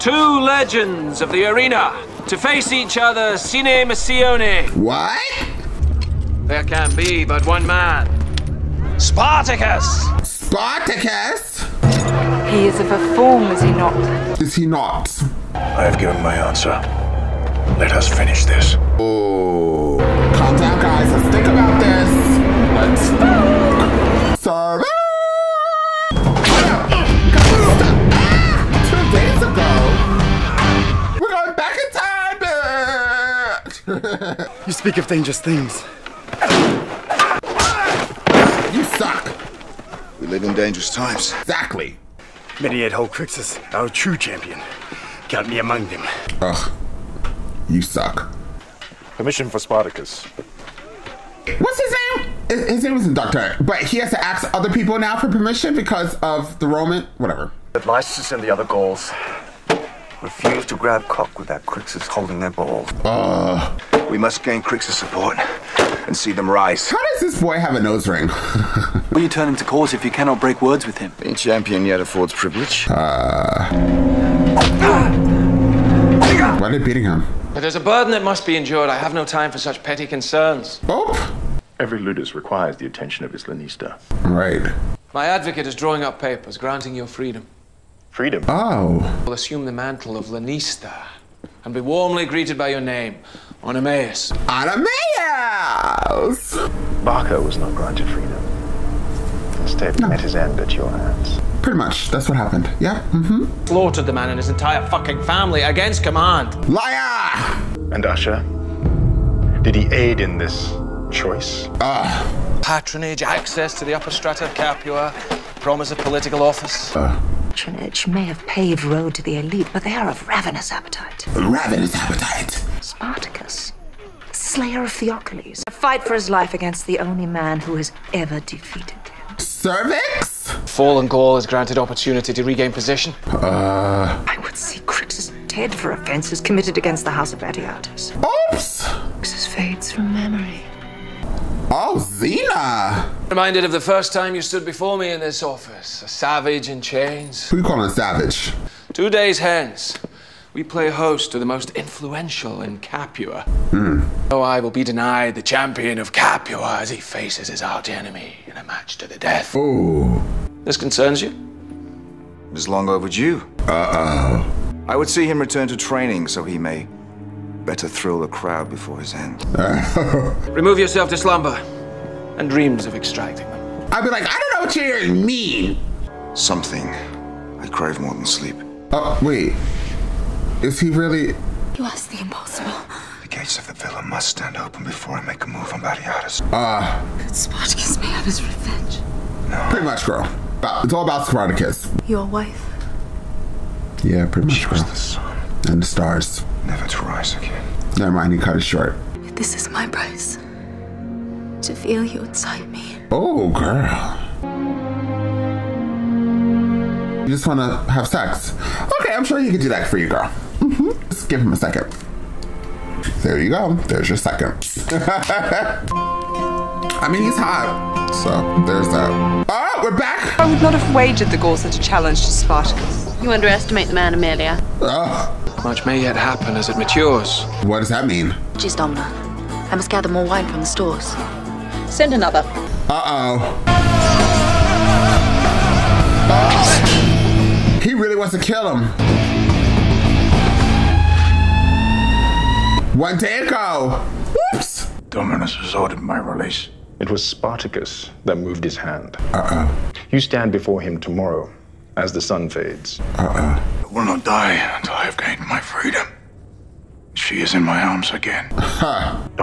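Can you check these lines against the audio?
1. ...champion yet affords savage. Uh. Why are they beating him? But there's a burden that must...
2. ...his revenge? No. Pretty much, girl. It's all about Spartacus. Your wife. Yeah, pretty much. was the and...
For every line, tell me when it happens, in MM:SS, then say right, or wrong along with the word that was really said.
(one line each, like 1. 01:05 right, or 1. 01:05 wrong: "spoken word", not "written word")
1. 01:11 wrong: "privilege", not "savage"
2. 03:08 right.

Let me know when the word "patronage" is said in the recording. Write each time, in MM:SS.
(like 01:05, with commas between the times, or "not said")
01:52, 01:57.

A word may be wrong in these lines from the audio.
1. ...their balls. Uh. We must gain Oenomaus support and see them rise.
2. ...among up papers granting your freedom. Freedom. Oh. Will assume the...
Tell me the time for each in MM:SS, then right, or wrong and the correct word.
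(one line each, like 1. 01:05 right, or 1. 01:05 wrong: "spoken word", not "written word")
1. 01:02 wrong: "Crixus", not "Oenomaus"
2. 01:25 wrong: "drawing", not "among".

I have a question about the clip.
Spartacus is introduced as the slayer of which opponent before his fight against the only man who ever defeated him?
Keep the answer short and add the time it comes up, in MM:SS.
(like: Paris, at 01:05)
Theocles, at 02:04.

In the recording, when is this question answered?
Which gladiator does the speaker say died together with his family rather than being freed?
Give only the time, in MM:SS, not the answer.
01:37.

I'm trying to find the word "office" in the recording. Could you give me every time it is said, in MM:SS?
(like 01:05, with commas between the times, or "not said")
01:56, 02:25.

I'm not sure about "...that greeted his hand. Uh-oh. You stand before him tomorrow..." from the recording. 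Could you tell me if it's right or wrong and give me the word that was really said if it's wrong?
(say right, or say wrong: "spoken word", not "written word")
wrong: "moved", not "greeted".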